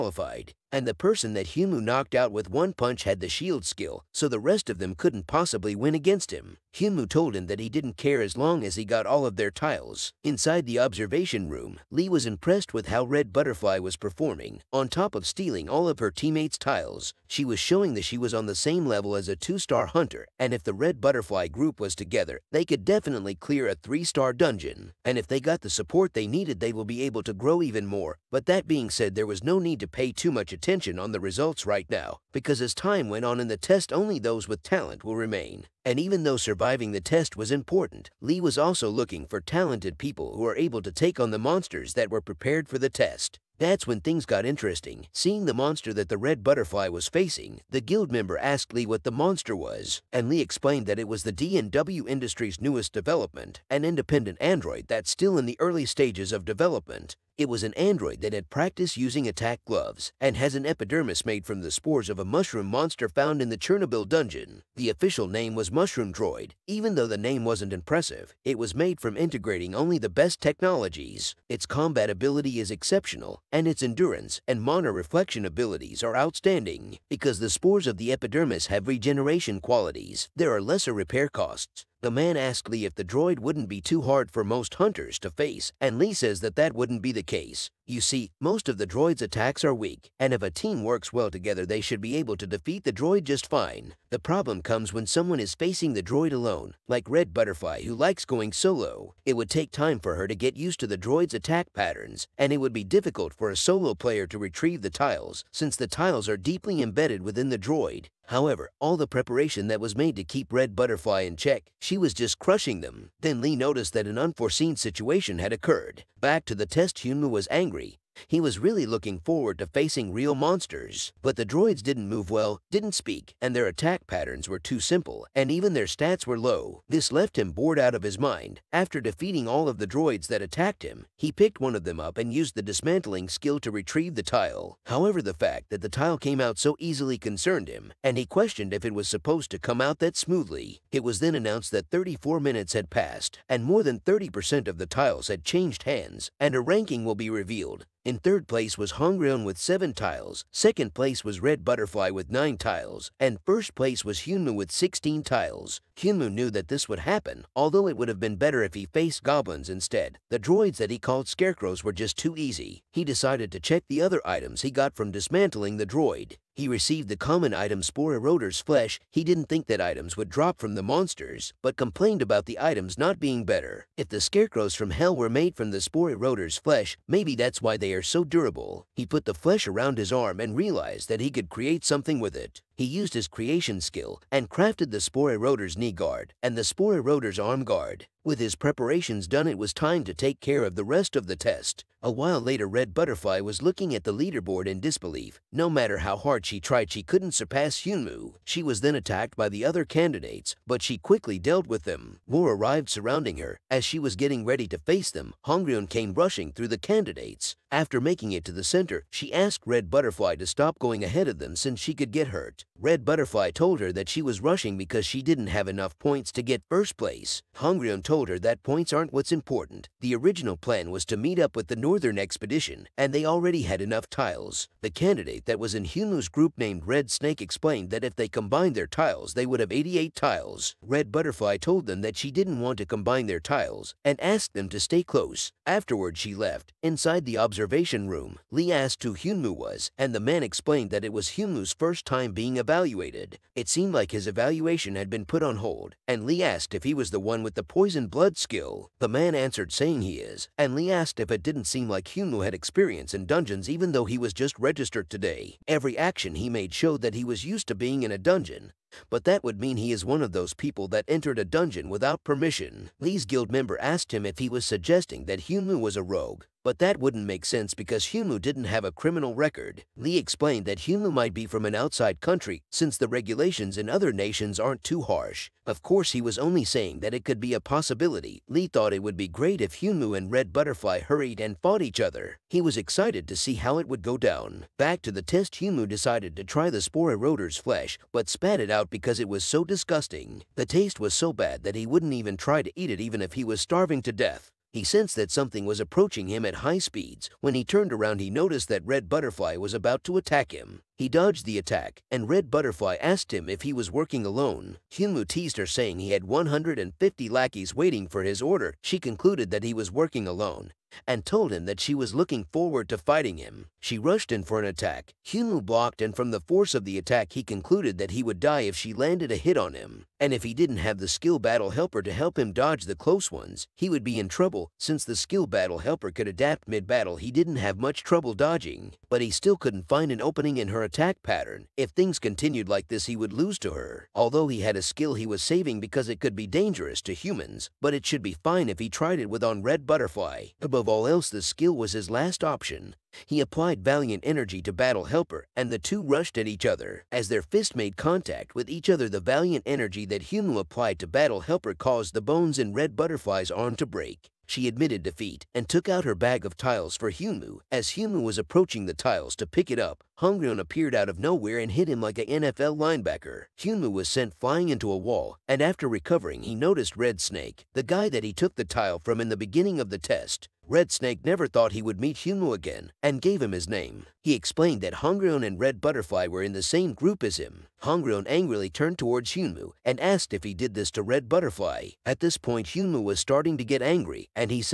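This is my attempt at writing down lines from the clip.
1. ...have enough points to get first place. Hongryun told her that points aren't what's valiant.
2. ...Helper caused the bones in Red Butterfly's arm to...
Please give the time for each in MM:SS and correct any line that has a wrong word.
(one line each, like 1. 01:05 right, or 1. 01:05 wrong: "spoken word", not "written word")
1. 03:35 wrong: "important", not "valiant"
2. 05:51 right.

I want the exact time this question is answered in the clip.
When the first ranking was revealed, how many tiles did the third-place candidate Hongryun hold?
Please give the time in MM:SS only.
02:29.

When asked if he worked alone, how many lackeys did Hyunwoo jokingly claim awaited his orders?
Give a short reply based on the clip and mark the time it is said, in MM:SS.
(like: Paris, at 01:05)
150, at 05:06.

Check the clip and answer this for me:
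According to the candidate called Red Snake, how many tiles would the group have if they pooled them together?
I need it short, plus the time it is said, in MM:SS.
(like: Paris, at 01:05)
88, at 03:49.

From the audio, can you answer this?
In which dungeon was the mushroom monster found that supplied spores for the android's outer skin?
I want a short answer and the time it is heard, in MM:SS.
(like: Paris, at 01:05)
Chernobyl, at 01:03.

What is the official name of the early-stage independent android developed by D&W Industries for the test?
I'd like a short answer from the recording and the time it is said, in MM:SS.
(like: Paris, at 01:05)
Mushroom Droid, at 01:05.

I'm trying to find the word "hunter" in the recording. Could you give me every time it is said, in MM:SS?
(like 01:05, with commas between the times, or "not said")
00:19, 01:24.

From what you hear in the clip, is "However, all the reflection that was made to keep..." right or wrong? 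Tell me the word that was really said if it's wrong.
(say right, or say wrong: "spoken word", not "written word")
wrong: "preparation", not "reflection".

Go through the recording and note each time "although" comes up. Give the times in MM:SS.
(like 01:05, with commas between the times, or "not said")
02:37, 05:34.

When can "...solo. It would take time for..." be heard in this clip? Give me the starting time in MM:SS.
01:38.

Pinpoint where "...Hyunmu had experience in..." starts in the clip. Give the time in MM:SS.
04:12.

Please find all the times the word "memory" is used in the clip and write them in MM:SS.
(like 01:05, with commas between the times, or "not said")
not said.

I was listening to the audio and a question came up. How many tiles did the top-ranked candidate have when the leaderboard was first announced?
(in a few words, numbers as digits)
16.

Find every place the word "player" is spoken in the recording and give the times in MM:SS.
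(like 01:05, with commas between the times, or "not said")
01:43.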